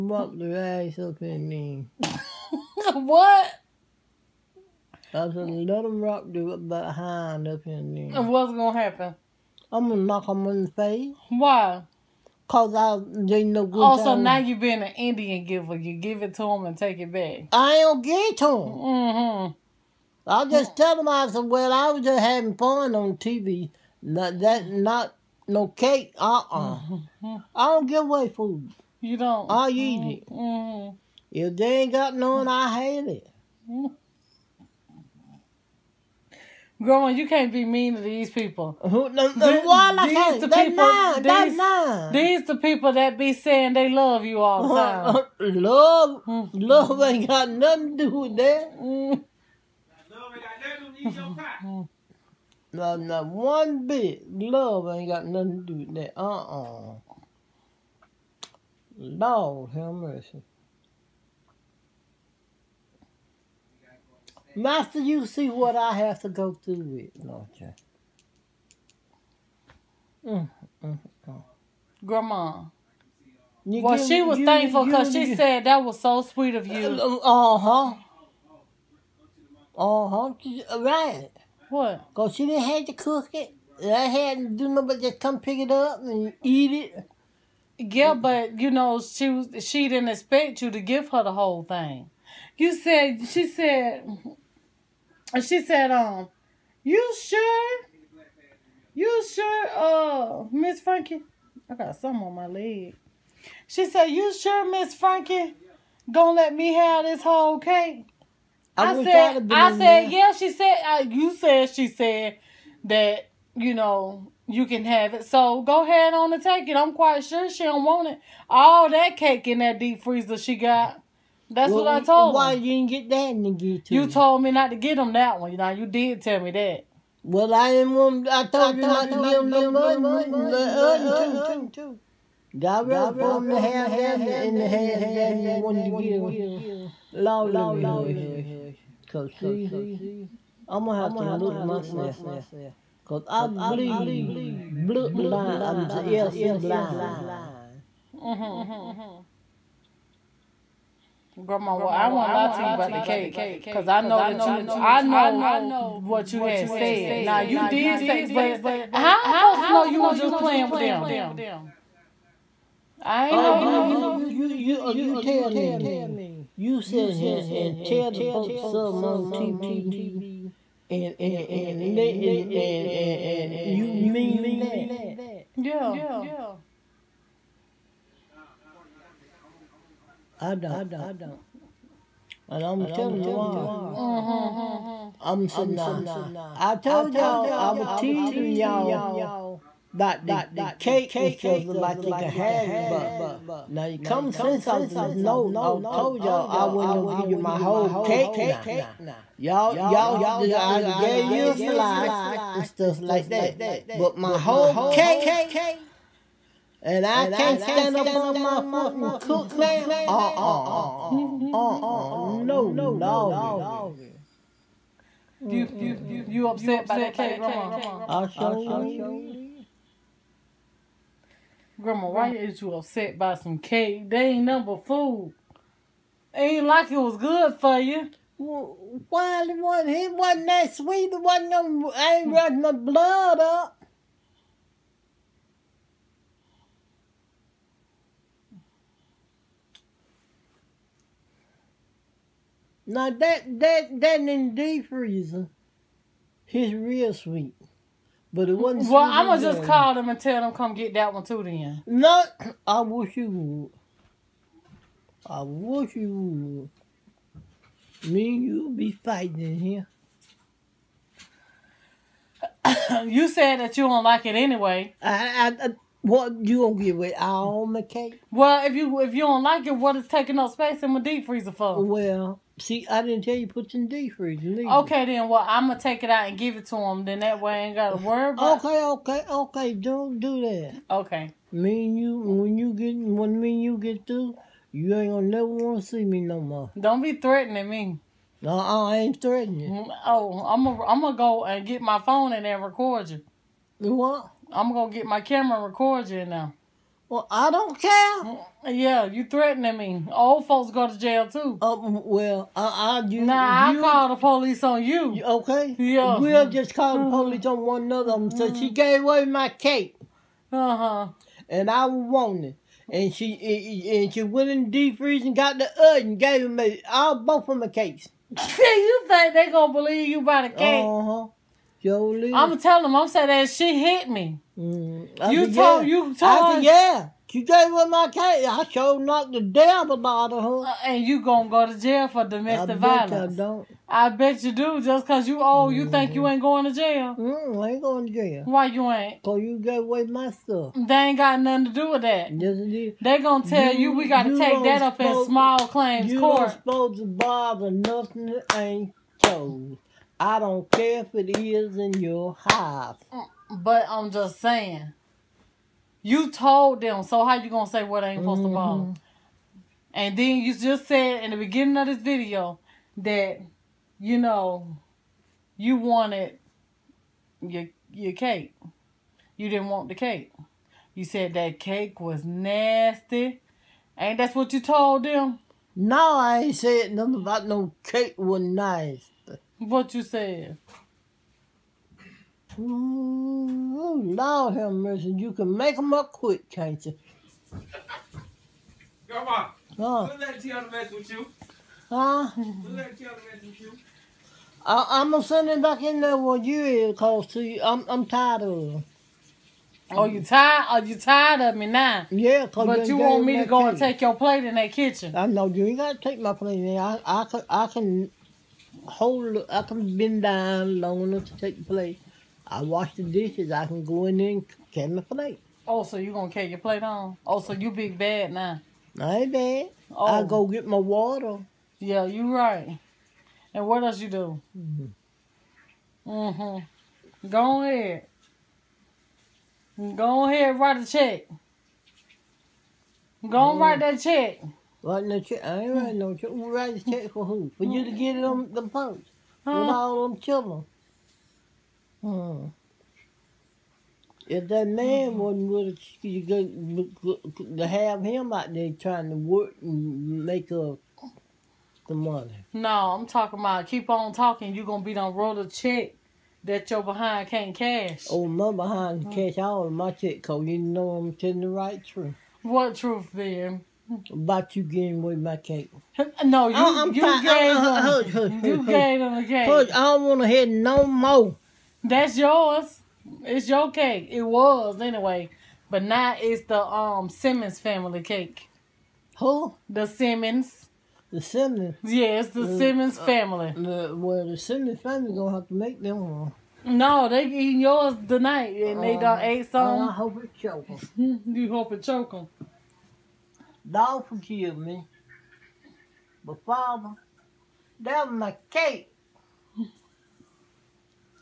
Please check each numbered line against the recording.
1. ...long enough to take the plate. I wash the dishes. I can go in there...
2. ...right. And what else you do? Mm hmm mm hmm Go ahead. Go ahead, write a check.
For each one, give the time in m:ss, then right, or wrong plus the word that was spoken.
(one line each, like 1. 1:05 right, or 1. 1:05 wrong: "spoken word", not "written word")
1. 6:50 right
2. 7:02 right.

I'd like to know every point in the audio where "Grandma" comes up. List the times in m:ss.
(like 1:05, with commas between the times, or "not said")
1:12, 2:31, 3:37, 3:41.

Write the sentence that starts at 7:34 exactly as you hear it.
You're gonna be done roll a check that your behind can't cash.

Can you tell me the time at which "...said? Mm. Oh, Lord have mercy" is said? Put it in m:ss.
6:20.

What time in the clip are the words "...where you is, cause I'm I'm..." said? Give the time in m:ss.
6:36.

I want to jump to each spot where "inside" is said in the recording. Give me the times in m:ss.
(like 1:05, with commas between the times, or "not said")
not said.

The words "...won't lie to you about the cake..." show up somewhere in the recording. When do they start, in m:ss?
2:32.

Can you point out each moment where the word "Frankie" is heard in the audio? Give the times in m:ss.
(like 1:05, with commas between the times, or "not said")
1:40, 1:44.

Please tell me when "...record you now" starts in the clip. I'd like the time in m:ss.
4:55.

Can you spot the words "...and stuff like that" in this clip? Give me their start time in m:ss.
3:22.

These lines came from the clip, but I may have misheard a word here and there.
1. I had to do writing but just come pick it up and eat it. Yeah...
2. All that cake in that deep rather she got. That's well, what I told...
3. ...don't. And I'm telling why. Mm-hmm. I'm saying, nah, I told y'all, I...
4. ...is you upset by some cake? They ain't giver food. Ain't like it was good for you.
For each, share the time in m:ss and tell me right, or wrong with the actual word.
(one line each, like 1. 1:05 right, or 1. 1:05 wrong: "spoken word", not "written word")
1. 1:23 wrong: "nothing", not "writing"
2. 1:58 wrong: "freezer", not "rather"
3. 3:00 right
4. 3:42 wrong: "number", not "giver".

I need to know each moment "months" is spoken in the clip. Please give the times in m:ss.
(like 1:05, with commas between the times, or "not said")
not said.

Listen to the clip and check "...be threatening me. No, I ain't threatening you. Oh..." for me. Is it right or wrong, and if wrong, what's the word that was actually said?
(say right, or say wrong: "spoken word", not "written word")
right.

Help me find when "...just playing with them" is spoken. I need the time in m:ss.
2:40.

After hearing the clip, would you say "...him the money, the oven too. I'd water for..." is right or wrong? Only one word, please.
wrong.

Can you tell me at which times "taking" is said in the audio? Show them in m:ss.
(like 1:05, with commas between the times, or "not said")
4:30.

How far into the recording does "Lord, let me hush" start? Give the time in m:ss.
2:17.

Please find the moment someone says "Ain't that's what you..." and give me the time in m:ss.
6:13.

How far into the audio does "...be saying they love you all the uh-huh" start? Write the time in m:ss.
0:43.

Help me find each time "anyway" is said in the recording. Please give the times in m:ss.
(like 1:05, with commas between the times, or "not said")
4:24, 7:54.